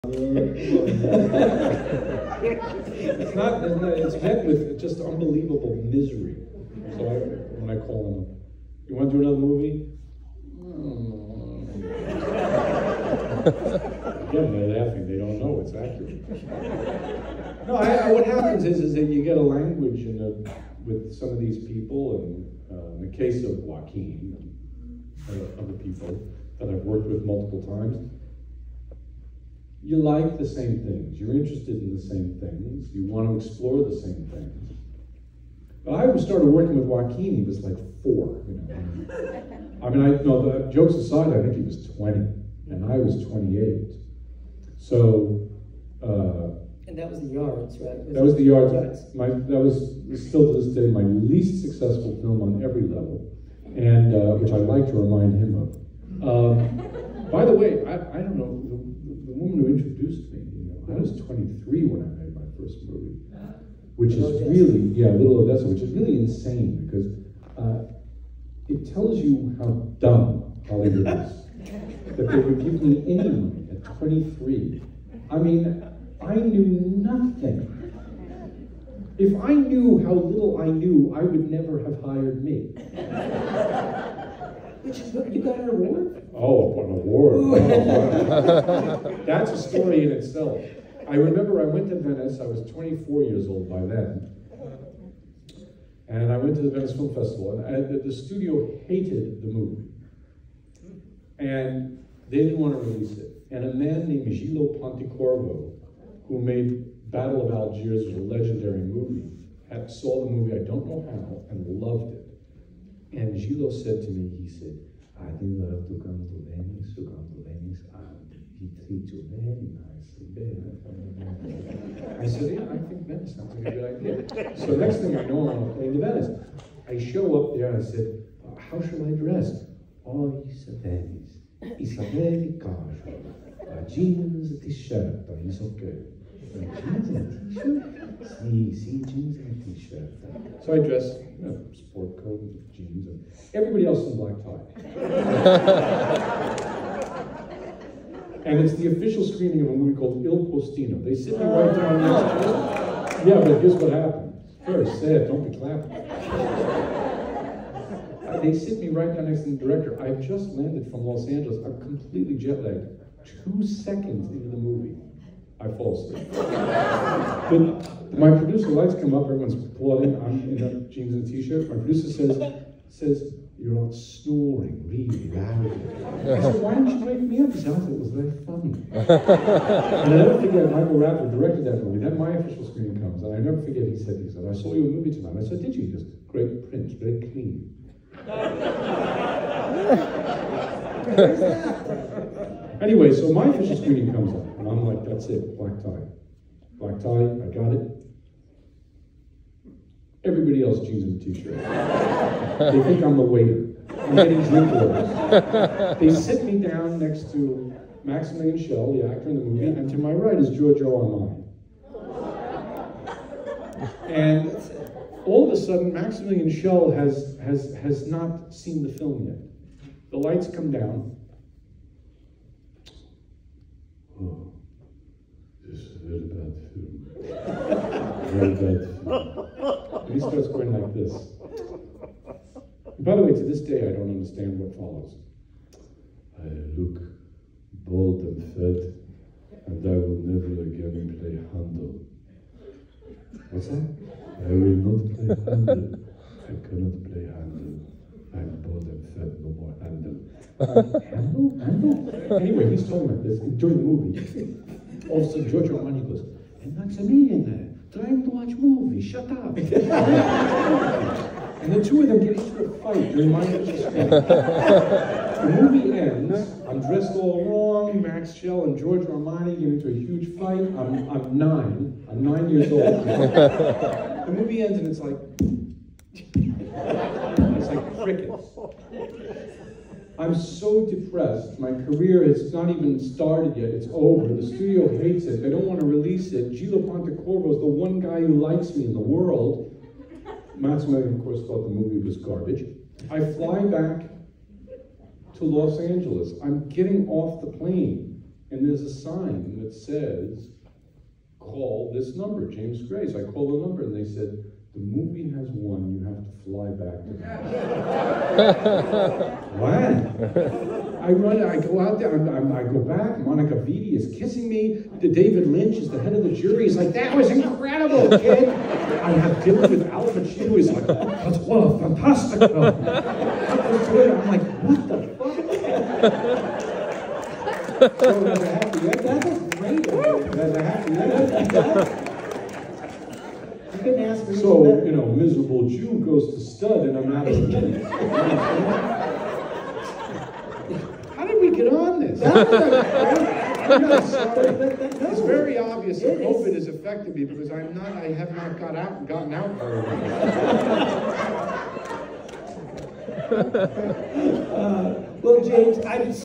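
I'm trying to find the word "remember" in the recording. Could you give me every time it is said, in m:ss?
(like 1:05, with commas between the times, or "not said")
1:31.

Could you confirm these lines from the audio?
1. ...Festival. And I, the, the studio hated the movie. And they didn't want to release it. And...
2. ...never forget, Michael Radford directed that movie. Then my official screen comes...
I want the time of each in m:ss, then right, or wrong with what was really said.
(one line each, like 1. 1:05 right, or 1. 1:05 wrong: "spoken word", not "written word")
1. 1:37 right
2. 3:00 right.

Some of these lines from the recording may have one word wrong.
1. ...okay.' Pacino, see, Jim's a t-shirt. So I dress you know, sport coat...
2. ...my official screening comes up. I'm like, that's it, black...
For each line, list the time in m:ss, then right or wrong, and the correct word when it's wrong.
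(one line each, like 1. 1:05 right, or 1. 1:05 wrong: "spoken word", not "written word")
1. 2:15 wrong: "See", not "Pacino"
2. 3:13 right.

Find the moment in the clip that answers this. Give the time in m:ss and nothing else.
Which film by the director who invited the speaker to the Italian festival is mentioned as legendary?
1:47.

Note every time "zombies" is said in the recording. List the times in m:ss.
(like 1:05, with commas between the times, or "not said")
not said.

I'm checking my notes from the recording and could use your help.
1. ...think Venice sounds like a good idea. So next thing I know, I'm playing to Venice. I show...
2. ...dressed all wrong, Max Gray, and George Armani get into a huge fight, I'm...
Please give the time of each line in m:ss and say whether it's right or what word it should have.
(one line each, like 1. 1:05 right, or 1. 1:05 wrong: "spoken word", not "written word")
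1. 2:02 right
2. 4:26 wrong: "Schell", not "Gray".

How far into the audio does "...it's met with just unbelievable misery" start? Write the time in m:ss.
0:03.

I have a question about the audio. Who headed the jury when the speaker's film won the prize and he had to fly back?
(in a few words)
David Lynch.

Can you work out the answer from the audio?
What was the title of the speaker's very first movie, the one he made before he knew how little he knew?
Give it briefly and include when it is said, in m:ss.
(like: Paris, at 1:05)
Little Odessa, at 1:05.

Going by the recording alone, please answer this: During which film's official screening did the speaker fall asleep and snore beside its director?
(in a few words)
Il Postino.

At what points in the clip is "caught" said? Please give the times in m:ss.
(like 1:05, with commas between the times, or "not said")
not said.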